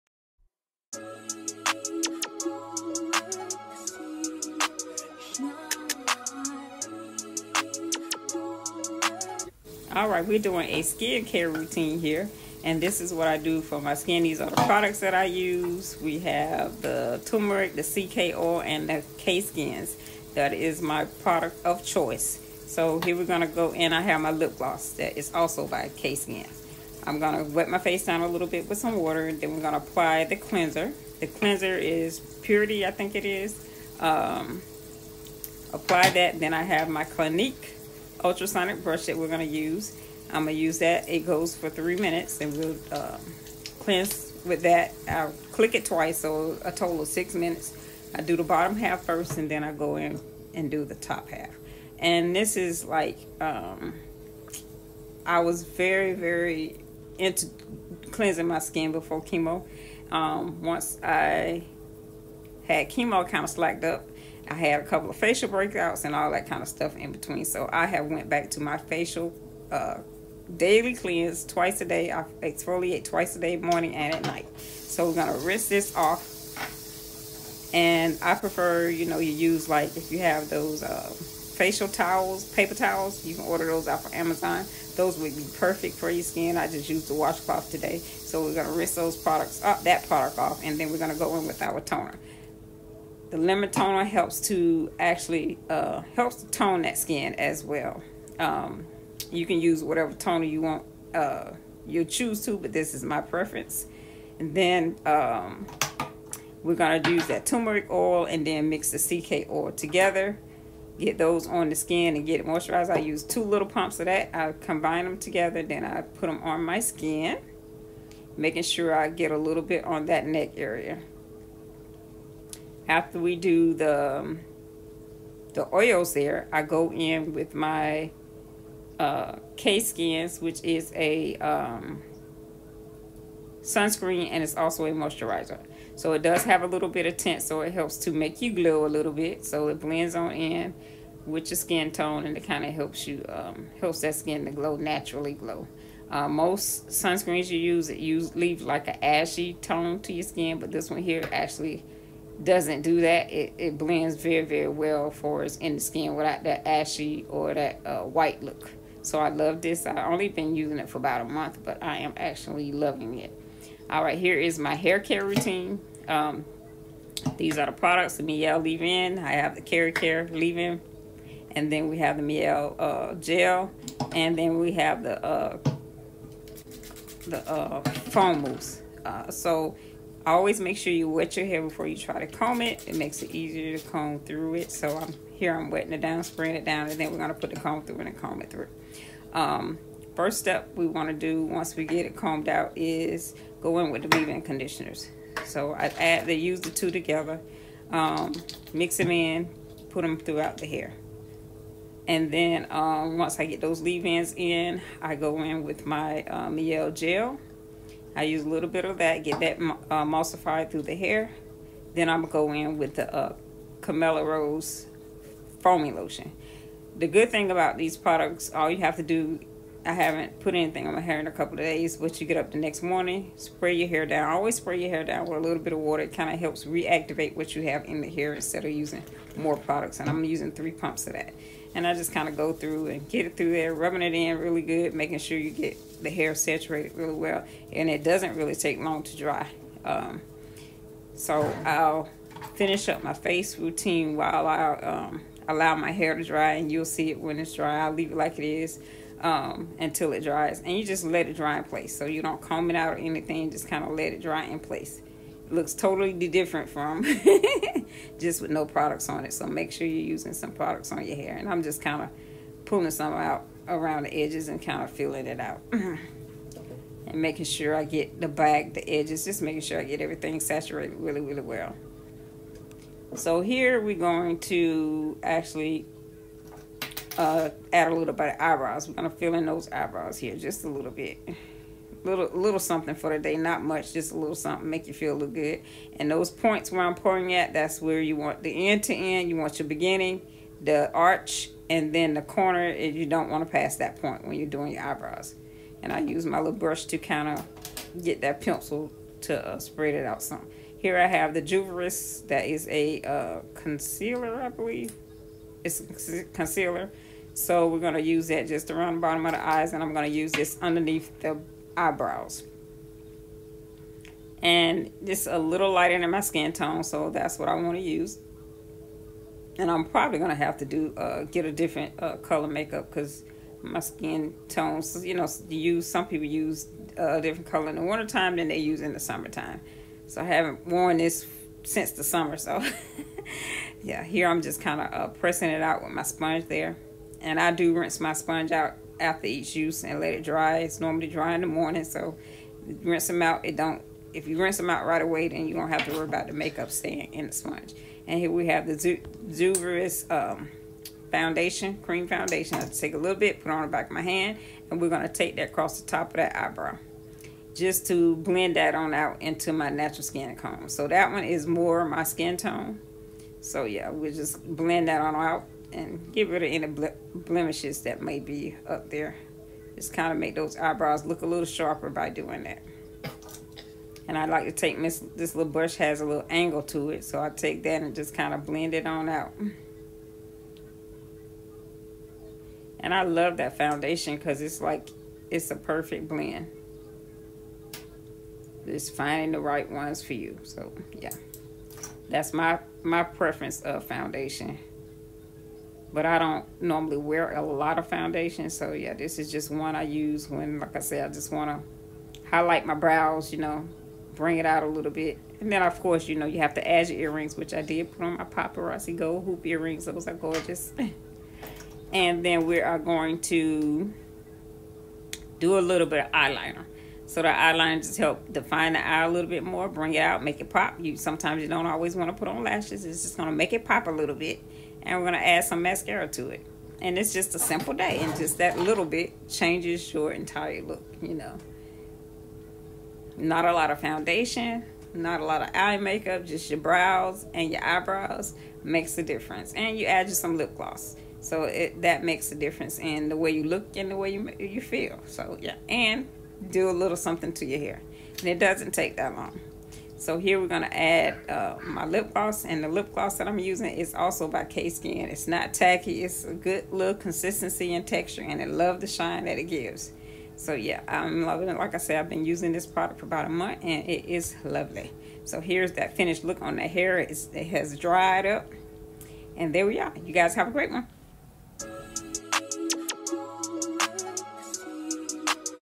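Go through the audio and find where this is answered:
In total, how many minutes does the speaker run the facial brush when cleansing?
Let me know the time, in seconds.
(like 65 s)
47 s.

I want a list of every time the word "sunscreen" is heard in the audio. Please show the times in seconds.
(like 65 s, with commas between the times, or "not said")
133 s, 146 s.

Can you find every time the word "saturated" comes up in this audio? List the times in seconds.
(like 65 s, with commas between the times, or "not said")
236 s, 270 s.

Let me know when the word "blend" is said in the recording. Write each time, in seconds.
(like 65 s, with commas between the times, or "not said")
139 s, 153 s, 358 s, 364 s, 378 s, 386 s.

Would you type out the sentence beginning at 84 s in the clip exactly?
Those would be perfect for your skin.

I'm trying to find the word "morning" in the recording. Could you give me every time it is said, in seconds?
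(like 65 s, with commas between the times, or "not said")
73 s, 222 s, 341 s.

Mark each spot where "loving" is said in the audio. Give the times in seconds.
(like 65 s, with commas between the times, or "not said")
162 s, 461 s.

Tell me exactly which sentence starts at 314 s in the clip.
And just a little lighter than my skin tone, so that's what I want to use.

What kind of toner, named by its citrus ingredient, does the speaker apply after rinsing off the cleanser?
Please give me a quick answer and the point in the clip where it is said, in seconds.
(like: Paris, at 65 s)
Lemon toner, at 93 s.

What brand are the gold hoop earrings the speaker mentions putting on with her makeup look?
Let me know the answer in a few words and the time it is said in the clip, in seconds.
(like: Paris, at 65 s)
Paparazzi, at 408 s.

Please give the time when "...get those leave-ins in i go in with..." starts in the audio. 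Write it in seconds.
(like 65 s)
203 s.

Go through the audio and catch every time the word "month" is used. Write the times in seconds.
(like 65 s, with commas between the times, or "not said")
161 s, 463 s.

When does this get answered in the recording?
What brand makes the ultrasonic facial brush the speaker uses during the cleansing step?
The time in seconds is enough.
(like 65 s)
37 s.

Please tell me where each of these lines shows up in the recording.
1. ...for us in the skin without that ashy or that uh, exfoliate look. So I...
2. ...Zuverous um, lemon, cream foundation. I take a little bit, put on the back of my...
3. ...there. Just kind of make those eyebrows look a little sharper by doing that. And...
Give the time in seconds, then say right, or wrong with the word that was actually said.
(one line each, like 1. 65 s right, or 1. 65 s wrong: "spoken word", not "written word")
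1. 155 s wrong: "white", not "exfoliate"
2. 348 s wrong: "foundation", not "lemon"
3. 368 s right.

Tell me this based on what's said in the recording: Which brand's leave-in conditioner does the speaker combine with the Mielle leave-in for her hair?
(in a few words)
Kera Care.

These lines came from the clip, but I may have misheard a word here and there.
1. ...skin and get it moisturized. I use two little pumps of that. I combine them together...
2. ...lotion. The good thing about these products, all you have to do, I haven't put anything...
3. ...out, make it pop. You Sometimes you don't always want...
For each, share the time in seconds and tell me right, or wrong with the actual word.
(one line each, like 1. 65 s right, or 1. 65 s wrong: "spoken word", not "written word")
1. 111 s right
2. 215 s right
3. 420 s right.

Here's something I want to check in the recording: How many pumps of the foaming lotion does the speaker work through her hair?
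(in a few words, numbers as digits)
3.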